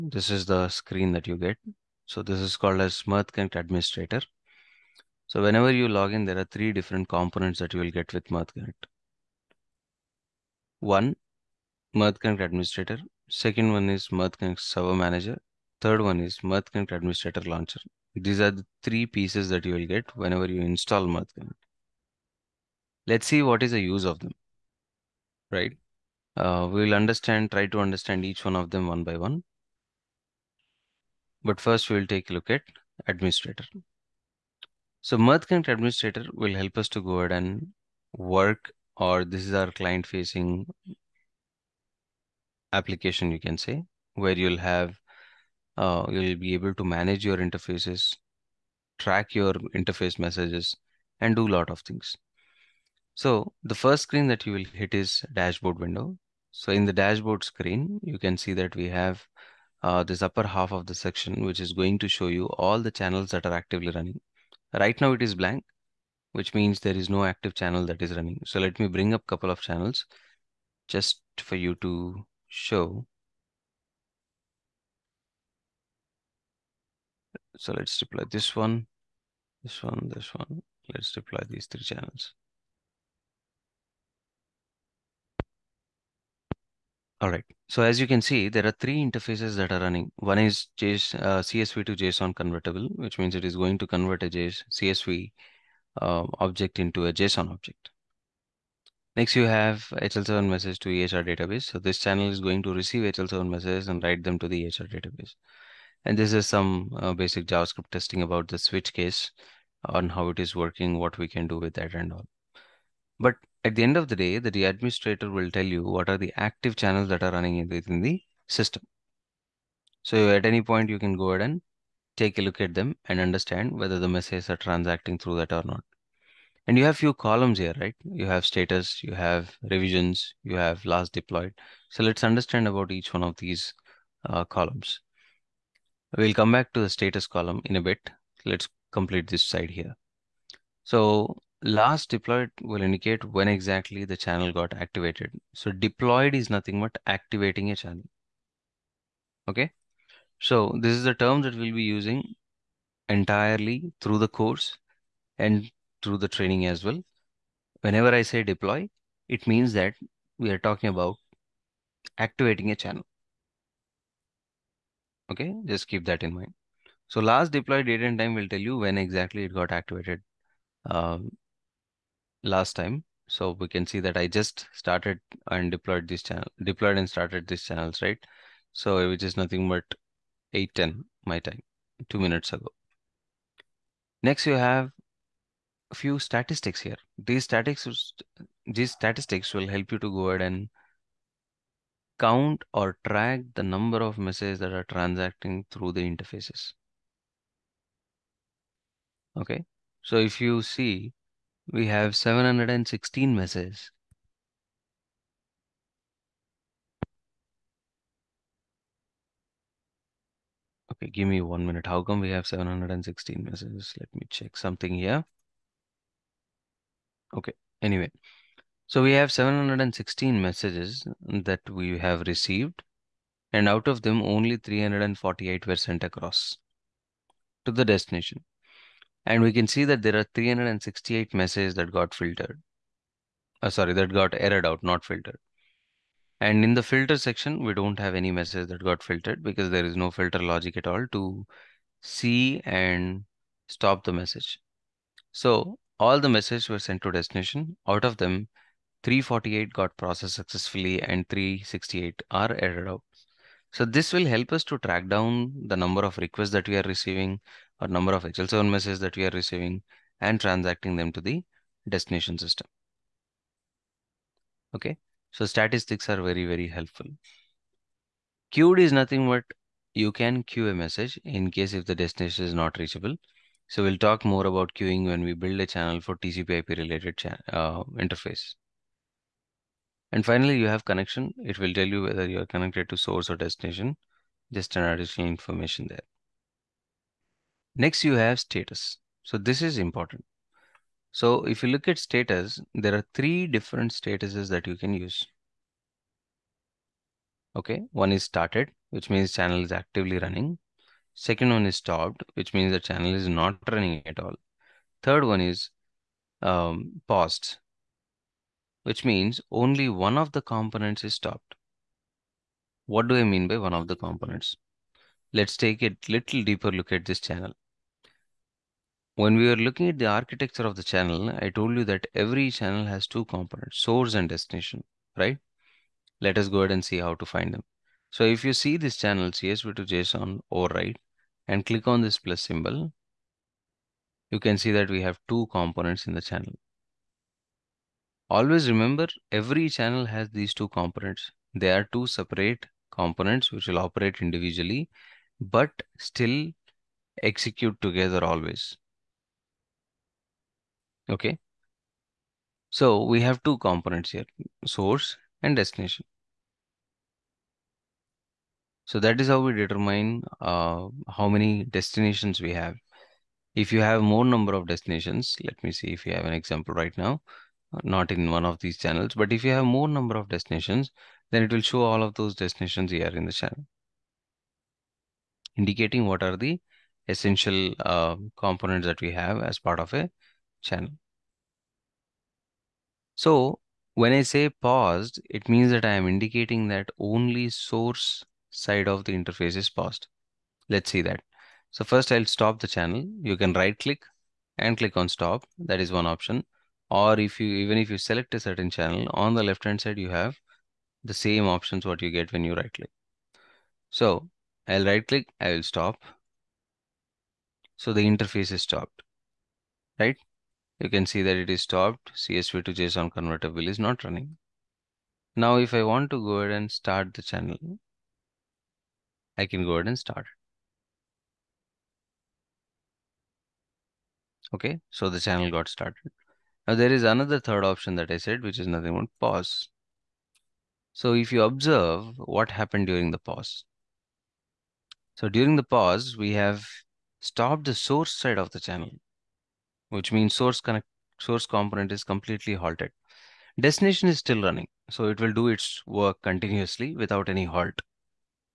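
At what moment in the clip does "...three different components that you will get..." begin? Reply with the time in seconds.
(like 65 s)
6 s.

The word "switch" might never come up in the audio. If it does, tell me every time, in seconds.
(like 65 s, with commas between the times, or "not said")
108 s.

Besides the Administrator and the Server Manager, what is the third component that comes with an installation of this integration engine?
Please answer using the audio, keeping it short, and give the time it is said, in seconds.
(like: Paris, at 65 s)
Mirth Connect Administrator Launcher, at 16 s.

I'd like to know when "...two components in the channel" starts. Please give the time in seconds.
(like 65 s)
335 s.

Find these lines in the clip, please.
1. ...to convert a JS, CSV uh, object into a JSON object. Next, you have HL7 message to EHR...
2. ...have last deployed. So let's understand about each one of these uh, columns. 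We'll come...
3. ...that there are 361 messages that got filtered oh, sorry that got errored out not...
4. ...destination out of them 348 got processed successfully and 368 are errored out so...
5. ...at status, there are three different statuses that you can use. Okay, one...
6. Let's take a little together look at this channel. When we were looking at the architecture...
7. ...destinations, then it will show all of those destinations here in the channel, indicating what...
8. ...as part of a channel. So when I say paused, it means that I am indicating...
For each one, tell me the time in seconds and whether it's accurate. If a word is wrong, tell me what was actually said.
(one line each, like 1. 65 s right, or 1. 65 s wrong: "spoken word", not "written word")
1. 93 s right
2. 130 s right
3. 229 s wrong: "368", not "361"
4. 247 s right
5. 291 s right
6. 315 s wrong: "deeper", not "together"
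7. 370 s right
8. 379 s right.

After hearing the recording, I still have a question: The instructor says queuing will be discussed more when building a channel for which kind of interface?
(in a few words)
TCP IP.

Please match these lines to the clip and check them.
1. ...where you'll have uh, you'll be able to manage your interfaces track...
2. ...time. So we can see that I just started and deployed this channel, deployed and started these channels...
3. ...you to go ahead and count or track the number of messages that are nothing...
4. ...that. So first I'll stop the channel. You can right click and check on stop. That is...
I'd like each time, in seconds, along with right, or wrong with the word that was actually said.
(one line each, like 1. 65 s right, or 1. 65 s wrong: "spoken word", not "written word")
1. 44 s right
2. 172 s right
3. 189 s wrong: "transacting", not "nothing"
4. 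391 s wrong: "click", not "check".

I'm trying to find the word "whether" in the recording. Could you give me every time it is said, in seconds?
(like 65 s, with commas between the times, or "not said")
123 s, 282 s.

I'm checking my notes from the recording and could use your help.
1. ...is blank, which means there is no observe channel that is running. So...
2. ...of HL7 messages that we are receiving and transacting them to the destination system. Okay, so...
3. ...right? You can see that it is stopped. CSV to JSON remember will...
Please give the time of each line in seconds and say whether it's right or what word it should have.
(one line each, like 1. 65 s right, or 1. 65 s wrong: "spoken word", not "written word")
1. 65 s wrong: "active", not "observe"
2. 258 s right
3. 409 s wrong: "converter", not "remember".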